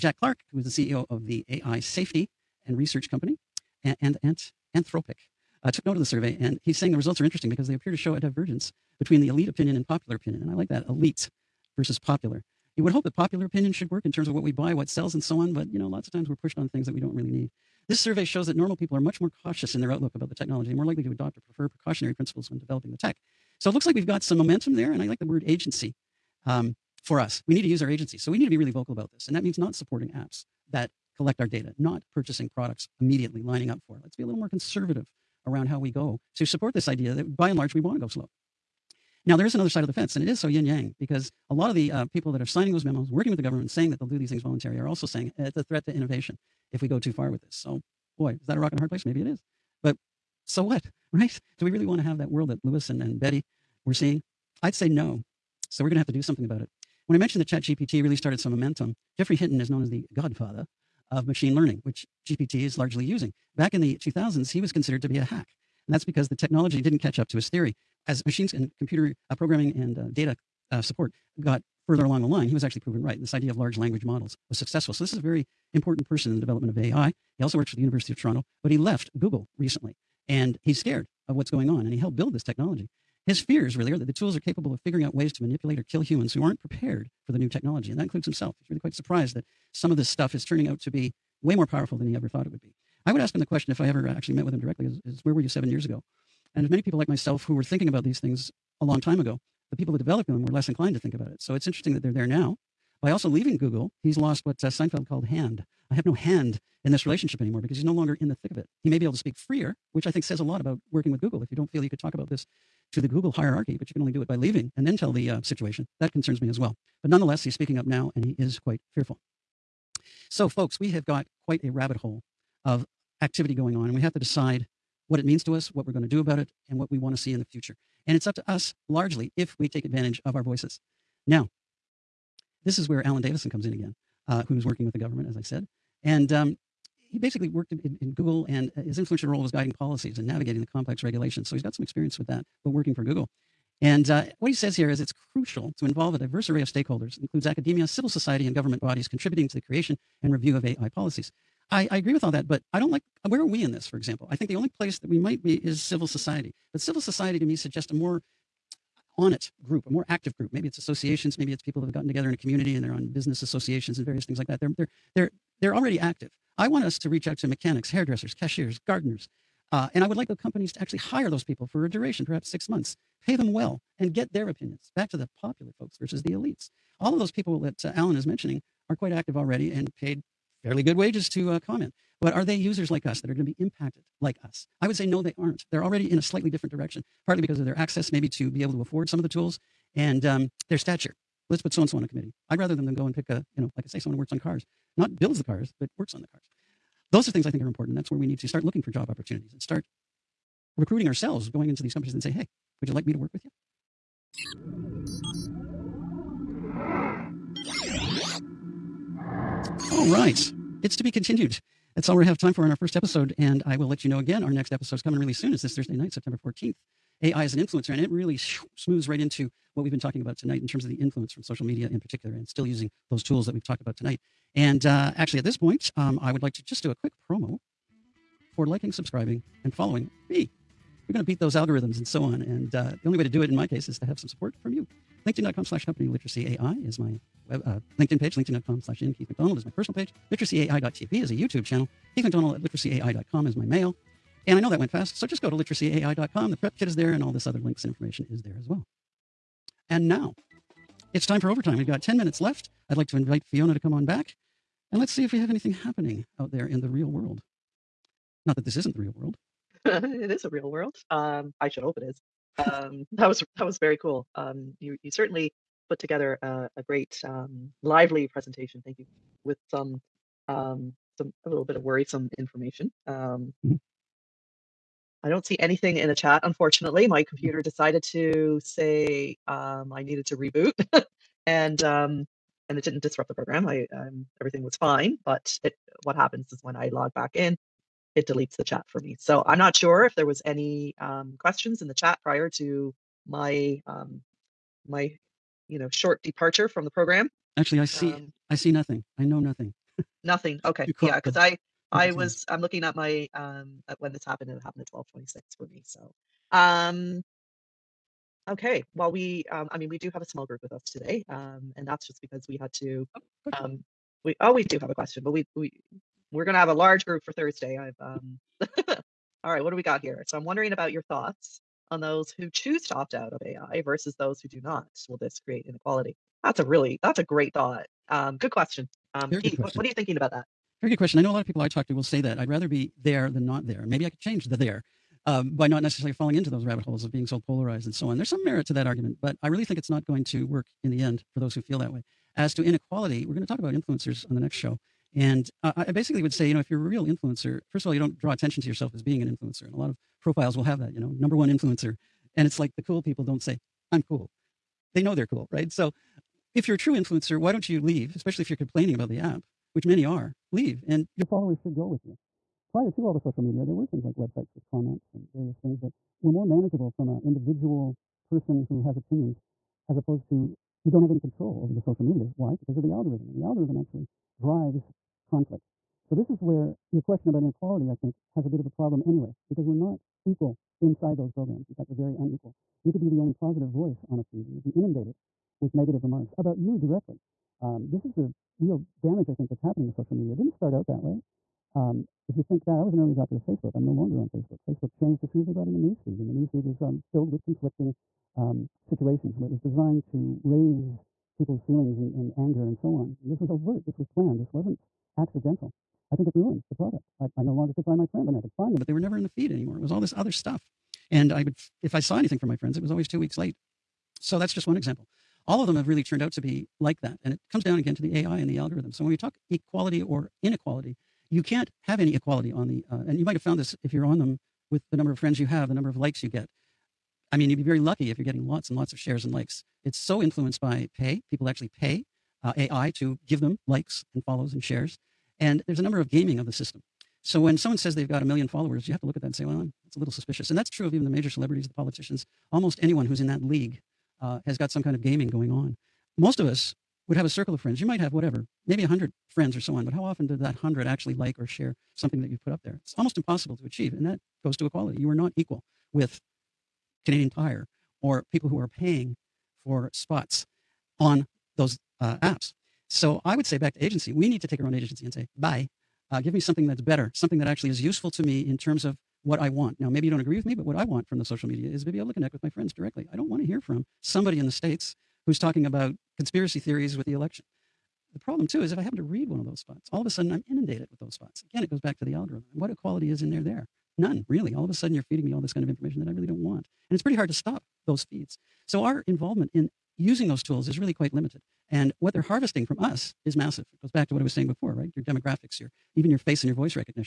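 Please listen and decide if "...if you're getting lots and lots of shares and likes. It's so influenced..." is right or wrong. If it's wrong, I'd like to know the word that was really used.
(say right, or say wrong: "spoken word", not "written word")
right.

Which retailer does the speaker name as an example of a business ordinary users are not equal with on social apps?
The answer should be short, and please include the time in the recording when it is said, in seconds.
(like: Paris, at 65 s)
Canadian Tire, at 457 s.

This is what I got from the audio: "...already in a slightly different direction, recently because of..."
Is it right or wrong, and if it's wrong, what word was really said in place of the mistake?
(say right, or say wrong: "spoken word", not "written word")
wrong: "partly", not "recently".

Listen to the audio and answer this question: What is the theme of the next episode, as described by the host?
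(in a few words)
AI as an influencer.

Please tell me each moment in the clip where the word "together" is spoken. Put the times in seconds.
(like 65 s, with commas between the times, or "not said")
162 s, 265 s.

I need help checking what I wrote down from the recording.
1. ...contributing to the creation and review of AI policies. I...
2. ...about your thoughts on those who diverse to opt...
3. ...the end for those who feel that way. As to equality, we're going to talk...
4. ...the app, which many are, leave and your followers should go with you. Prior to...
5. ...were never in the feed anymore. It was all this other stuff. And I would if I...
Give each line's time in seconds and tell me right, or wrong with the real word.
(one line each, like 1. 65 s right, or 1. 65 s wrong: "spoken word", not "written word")
1. 149 s right
2. 320 s wrong: "choose", not "diverse"
3. 340 s wrong: "inequality", not "equality"
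4. 359 s right
5. 408 s right.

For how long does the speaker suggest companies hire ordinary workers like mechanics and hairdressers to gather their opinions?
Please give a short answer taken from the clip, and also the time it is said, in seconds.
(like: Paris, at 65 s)
six months, at 172 s.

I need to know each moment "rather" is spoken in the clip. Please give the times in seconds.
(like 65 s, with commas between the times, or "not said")
192 s, 332 s.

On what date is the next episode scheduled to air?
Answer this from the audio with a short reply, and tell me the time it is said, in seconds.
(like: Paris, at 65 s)
September 14th, at 216 s.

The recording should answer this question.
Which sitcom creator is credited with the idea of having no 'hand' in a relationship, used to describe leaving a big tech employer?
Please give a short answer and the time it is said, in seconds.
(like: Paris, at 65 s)
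Seinfeld, at 104 s.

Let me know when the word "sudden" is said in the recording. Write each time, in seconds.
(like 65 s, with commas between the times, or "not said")
480 s, 484 s.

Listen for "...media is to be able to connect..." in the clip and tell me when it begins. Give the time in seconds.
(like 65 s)
471 s.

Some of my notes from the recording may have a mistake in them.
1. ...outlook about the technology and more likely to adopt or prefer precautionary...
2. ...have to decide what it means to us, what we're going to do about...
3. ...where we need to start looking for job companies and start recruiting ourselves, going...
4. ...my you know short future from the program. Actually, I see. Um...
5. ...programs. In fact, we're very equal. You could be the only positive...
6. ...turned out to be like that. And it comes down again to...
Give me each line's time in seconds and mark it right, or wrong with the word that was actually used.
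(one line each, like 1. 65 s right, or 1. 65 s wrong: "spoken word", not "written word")
1. 19 s right
2. 124 s right
3. 198 s wrong: "opportunities", not "companies"
4. 294 s wrong: "departure", not "future"
5. 381 s wrong: "unequal", not "equal"
6. 416 s right.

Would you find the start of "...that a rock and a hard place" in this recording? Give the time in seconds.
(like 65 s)
48 s.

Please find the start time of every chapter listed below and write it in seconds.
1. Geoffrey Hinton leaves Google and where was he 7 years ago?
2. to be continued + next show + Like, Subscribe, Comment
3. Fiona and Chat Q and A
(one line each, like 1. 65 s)
1. 51 s
2. 205 s
3. 254 s.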